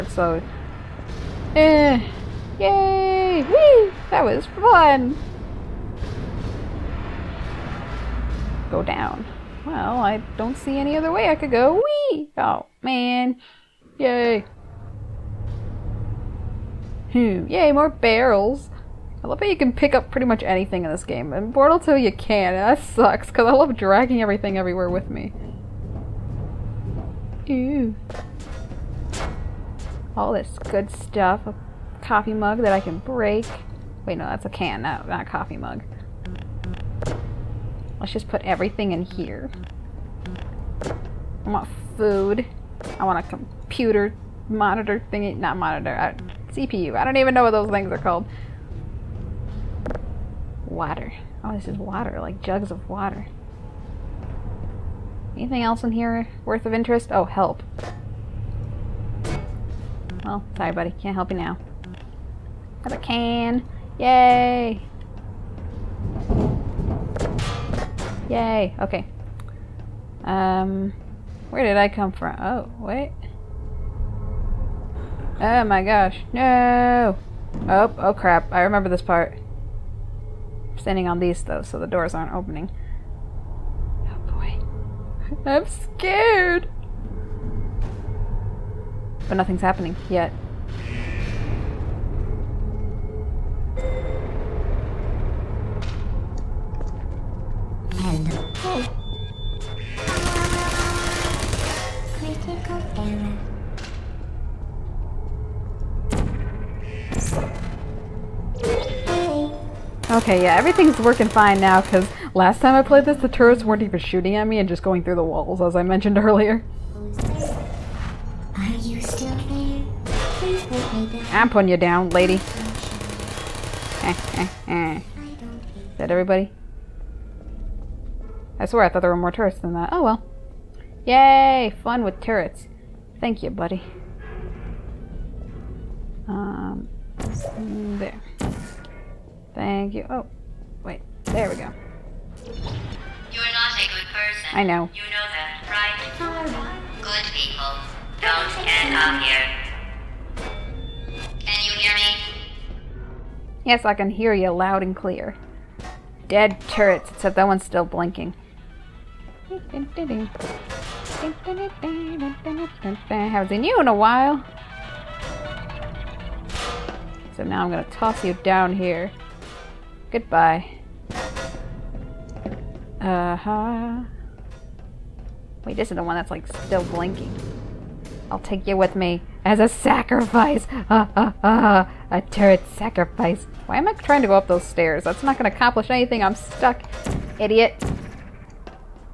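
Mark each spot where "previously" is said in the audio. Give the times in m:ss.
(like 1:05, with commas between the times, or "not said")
not said.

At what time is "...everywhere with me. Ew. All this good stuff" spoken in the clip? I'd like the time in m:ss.
0:24.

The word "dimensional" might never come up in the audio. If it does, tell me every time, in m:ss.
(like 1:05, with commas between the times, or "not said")
not said.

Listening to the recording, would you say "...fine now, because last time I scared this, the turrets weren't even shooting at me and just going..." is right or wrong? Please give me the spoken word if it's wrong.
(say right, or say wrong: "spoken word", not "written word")
wrong: "played", not "scared".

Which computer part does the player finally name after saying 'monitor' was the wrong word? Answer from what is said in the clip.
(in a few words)
CPU.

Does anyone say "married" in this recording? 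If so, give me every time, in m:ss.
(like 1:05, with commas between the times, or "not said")
not said.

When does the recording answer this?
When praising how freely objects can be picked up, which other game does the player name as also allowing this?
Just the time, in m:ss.
0:21.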